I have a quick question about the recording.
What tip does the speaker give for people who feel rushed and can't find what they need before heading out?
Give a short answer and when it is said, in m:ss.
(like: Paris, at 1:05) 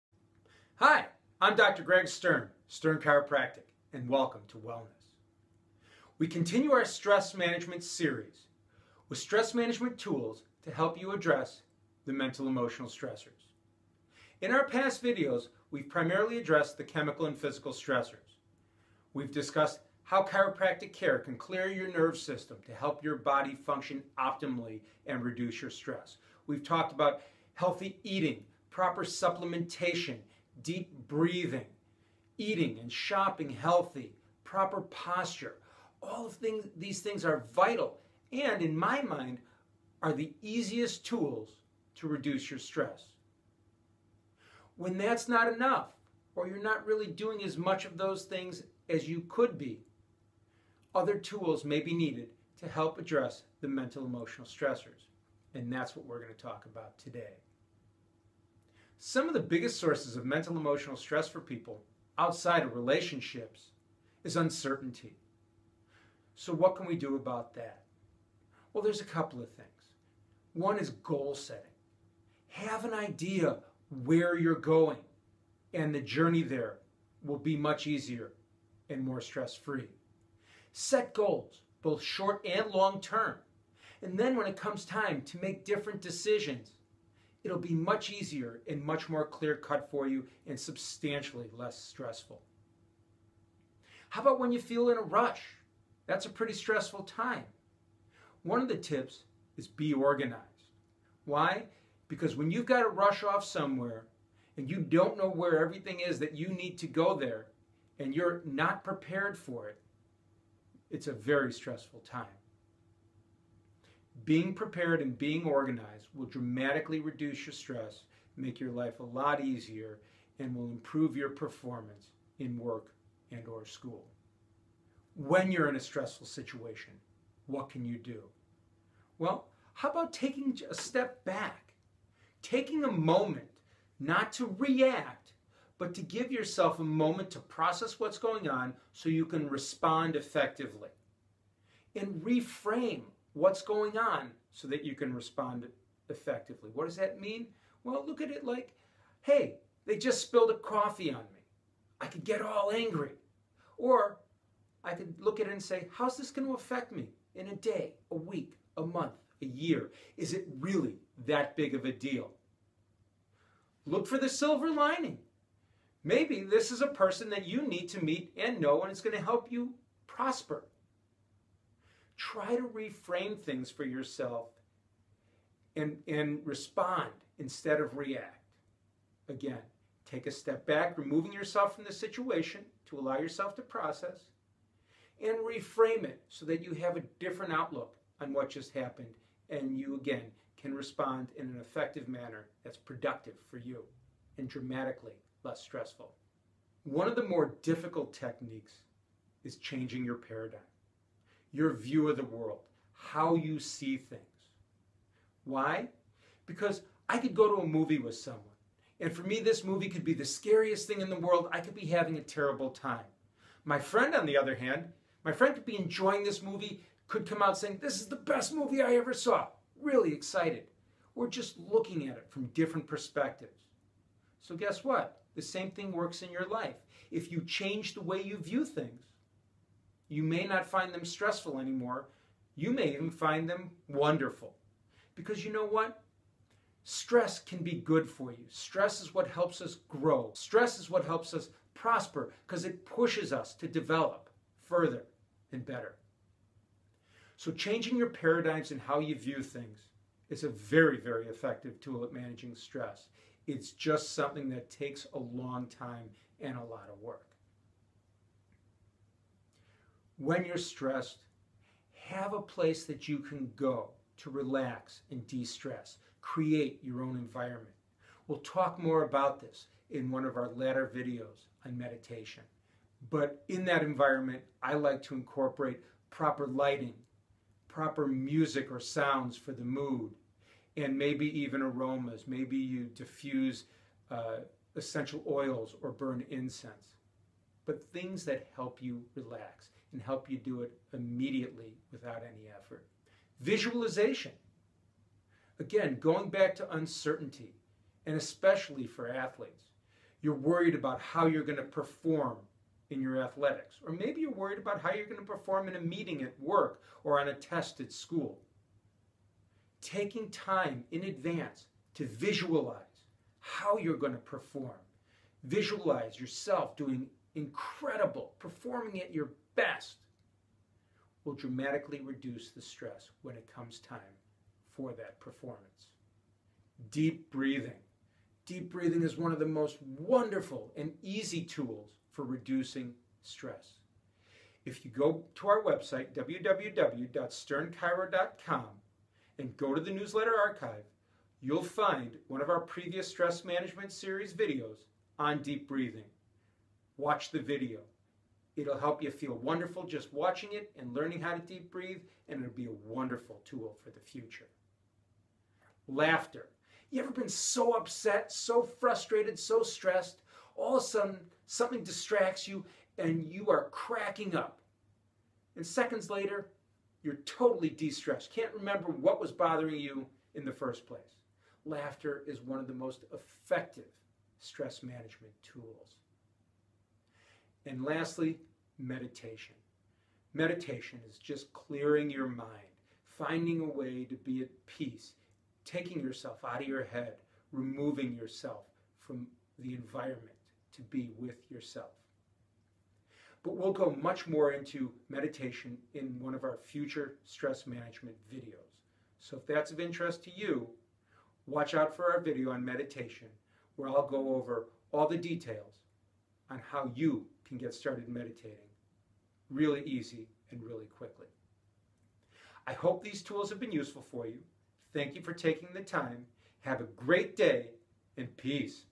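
Be organized, at 1:39.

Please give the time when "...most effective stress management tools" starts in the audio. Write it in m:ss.
6:12.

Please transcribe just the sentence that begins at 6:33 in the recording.
But we'll go much more into meditation in one of our future stress management videos.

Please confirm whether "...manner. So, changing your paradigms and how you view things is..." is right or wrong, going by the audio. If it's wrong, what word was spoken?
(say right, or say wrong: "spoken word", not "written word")
wrong: "better", not "manner".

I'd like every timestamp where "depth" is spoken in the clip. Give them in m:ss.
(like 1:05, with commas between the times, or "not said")
not said.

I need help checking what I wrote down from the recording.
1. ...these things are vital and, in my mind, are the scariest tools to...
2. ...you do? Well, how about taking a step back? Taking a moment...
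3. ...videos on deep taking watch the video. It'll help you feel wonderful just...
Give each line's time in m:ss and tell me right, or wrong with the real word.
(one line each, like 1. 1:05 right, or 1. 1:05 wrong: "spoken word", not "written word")
1. 0:36 wrong: "easiest", not "scariest"
2. 2:07 right
3. 5:44 wrong: "breathing", not "taking".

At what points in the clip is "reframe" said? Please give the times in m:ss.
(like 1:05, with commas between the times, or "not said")
2:22, 2:52, 3:05.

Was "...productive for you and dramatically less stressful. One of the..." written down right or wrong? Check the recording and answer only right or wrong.
right.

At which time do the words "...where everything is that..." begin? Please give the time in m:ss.
1:45.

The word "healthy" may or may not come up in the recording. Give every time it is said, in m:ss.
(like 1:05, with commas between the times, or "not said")
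0:27, 0:33.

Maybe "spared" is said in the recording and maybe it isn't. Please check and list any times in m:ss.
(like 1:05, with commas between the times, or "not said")
not said.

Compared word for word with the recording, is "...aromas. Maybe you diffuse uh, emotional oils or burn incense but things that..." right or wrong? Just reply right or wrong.
wrong.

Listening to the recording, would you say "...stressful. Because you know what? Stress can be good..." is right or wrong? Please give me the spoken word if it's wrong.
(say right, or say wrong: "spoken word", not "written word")
wrong: "wonderful", not "stressful".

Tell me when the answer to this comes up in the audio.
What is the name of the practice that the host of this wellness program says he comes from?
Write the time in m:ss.
0:02.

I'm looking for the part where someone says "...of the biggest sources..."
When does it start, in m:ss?
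0:59.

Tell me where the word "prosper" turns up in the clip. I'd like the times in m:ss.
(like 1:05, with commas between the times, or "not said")
2:50, 4:01.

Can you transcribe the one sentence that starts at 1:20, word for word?
Set goals, both short and long term.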